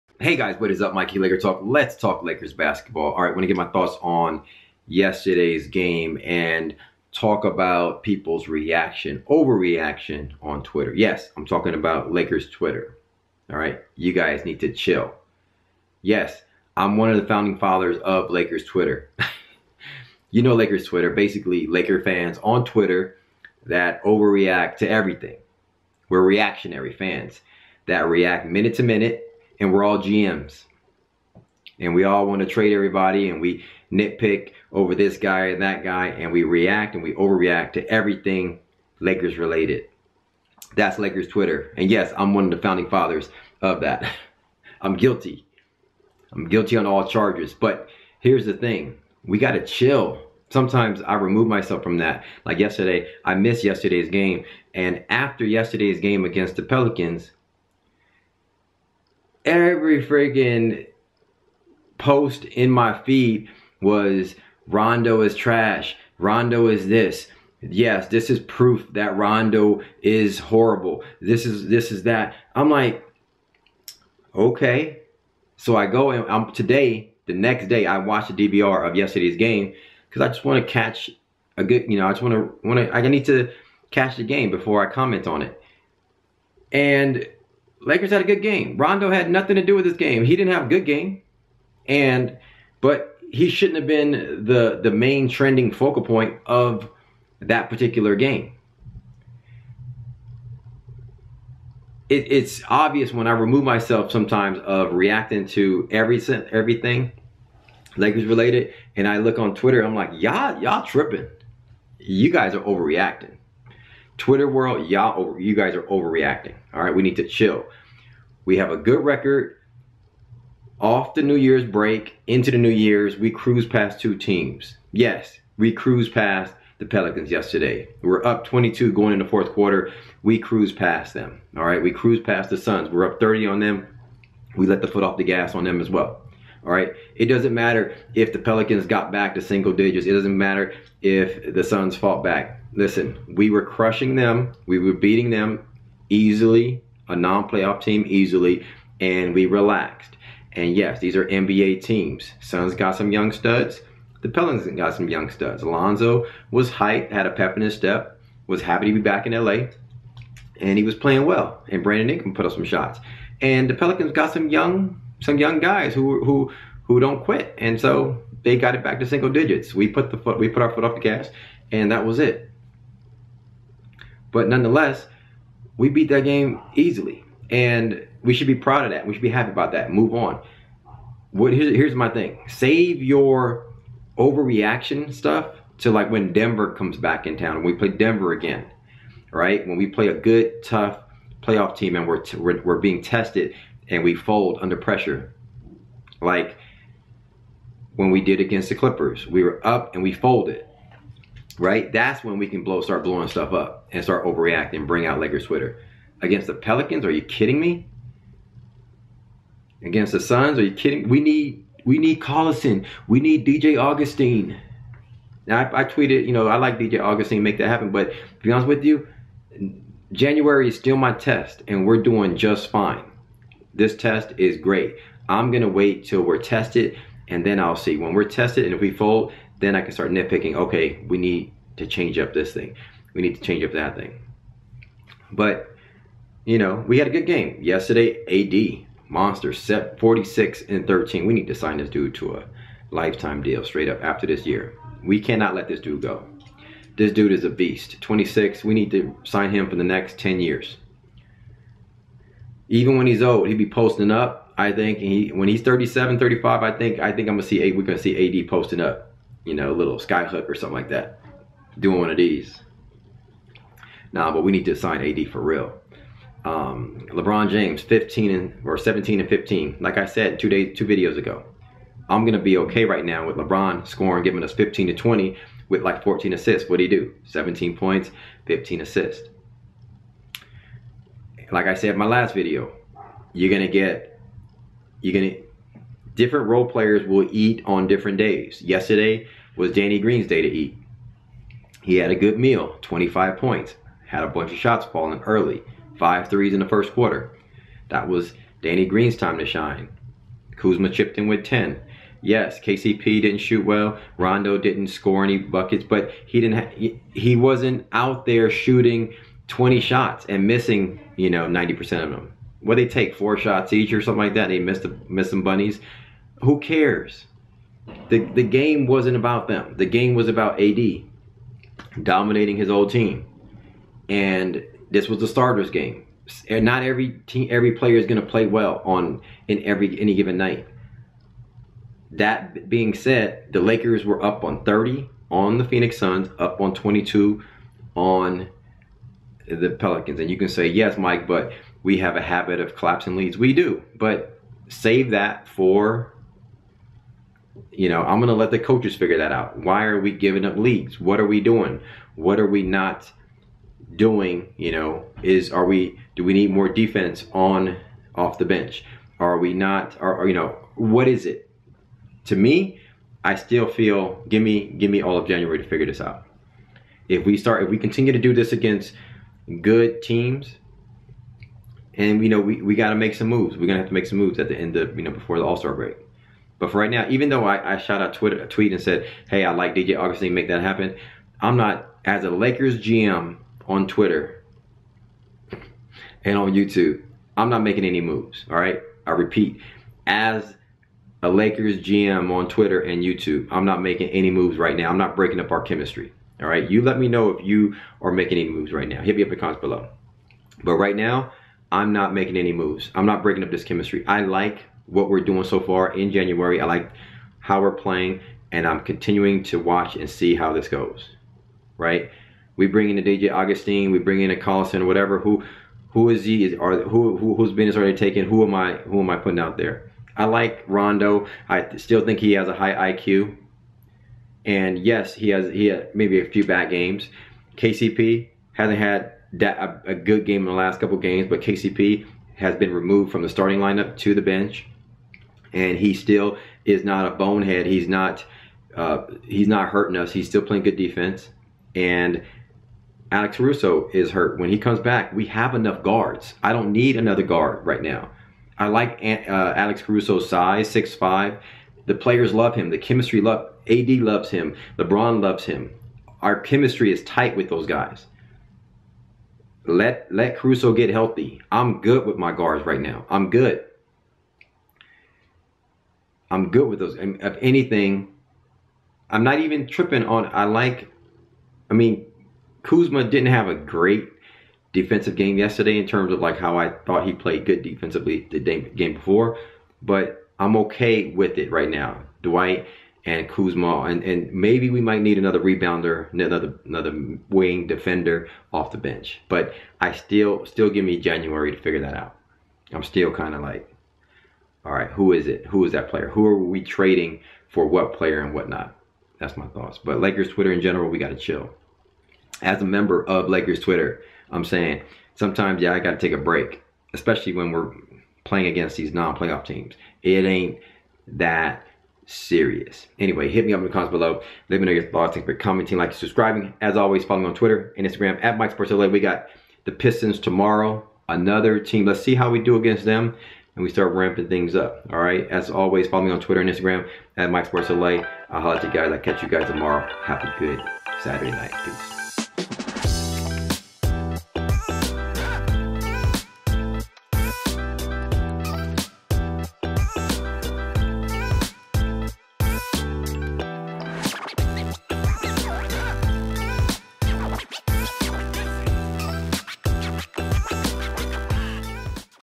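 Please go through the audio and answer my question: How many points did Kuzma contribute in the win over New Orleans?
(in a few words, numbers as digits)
10.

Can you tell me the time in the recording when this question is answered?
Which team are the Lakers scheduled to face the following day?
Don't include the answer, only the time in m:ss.
8:39.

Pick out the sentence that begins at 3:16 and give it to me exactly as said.
Like when we did against the Clippers, we were up and we folded.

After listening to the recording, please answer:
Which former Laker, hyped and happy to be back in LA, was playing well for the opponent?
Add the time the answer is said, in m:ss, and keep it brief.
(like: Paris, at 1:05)
Alonzo, at 2:35.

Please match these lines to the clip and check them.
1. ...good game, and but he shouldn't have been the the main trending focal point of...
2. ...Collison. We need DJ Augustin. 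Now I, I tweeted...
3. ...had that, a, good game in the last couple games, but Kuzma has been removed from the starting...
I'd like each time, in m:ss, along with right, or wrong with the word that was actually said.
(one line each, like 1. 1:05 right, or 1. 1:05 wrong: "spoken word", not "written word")
1. 1:30 right
2. 3:32 right
3. 7:08 wrong: "KCP", not "Kuzma".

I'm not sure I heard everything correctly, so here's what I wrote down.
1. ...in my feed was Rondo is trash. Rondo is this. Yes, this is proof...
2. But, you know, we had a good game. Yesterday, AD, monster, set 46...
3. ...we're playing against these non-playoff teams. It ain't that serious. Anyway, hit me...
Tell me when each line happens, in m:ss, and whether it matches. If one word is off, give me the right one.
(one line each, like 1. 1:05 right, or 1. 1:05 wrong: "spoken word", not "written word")
1. 1:02 right
2. 3:55 right
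3. 8:27 right.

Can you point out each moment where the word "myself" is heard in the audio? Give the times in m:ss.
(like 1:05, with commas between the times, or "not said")
0:51, 1:43.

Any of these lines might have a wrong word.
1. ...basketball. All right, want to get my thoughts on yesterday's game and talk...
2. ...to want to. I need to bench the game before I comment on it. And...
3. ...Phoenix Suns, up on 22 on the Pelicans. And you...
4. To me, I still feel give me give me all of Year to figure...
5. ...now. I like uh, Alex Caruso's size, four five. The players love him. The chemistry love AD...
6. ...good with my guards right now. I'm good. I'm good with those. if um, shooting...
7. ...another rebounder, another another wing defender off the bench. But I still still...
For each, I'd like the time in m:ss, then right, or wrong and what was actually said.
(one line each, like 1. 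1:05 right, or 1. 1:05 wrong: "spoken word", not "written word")
1. 0:02 right
2. 1:22 wrong: "catch", not "bench"
3. 5:35 right
4. 6:02 wrong: "January", not "Year"
5. 7:27 wrong: "six", not "four"
6. 7:41 wrong: "anything", not "shooting"
7. 8:05 right.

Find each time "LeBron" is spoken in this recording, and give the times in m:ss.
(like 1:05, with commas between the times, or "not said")
4:27, 4:33, 7:34.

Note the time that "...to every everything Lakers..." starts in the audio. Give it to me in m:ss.
1:45.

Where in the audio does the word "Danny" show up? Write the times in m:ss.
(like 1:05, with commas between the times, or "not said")
4:49, 4:58.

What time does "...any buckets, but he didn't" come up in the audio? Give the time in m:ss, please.
5:05.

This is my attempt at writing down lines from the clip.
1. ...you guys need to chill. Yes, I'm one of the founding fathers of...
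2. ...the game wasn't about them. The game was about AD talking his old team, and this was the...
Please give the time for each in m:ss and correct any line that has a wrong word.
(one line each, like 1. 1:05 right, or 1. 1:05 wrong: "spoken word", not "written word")
1. 0:13 right
2. 5:18 wrong: "dominating", not "talking".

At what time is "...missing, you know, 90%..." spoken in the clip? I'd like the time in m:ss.
5:10.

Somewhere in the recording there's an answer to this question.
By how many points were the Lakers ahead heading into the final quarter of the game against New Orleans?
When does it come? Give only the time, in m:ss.
2:08.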